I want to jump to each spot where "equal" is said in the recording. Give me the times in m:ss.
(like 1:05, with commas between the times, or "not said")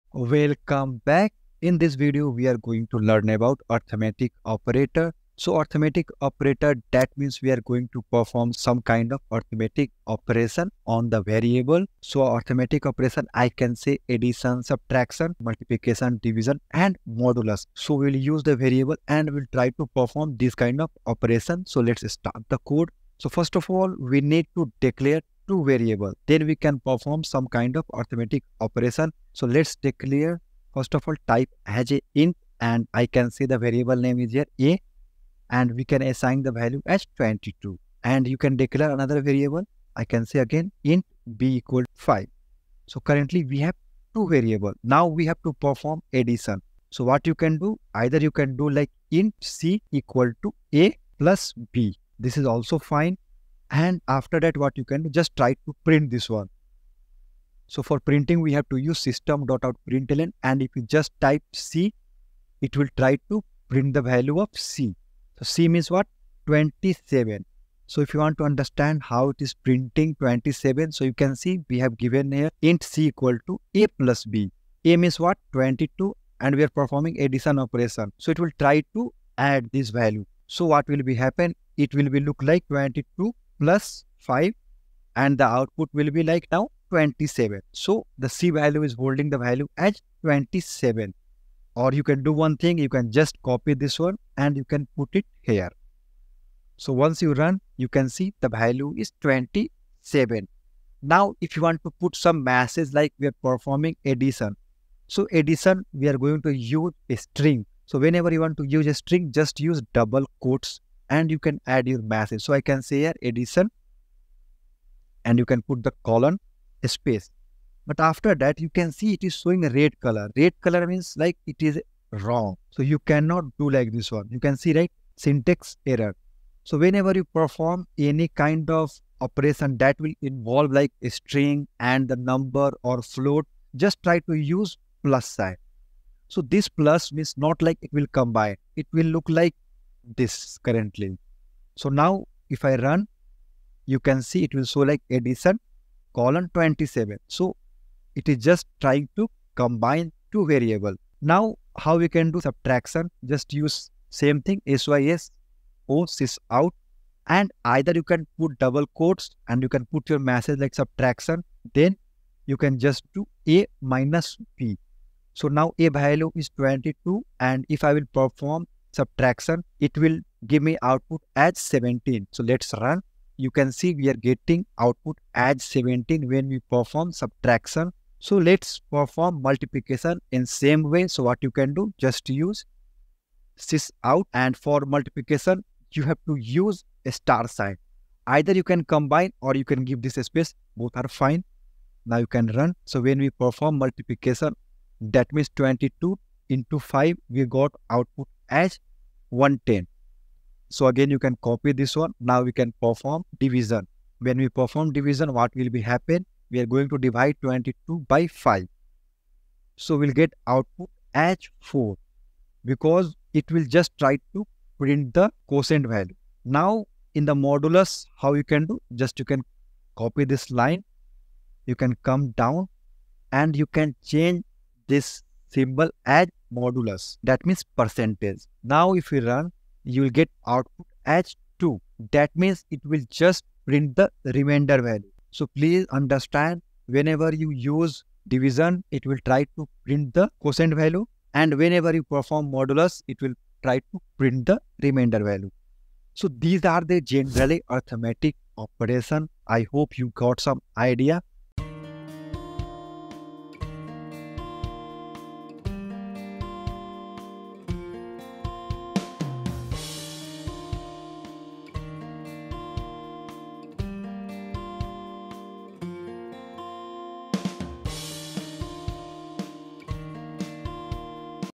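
0:41, 0:49, 1:13.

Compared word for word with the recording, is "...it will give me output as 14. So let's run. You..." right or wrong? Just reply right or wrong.
wrong.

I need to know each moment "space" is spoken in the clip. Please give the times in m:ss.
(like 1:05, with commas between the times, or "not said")
1:56, 3:10.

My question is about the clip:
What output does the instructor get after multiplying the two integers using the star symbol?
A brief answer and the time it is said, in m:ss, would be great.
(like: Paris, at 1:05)
110, at 3:19.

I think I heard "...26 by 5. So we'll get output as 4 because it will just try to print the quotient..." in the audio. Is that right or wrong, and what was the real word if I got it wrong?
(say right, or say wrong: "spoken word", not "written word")
wrong: "22", not "26".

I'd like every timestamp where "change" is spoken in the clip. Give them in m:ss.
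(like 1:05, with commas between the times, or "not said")
3:44.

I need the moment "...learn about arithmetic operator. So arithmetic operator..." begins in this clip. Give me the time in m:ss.
0:02.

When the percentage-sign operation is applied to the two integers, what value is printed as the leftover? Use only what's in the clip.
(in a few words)
2.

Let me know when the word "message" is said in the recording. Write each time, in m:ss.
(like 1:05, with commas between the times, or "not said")
1:52, 2:40.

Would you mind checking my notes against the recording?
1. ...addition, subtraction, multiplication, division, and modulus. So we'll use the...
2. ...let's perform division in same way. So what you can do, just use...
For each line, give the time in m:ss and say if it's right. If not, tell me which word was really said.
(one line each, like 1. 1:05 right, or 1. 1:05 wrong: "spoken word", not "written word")
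1. 0:14 right
2. 2:58 wrong: "multiplication", not "division".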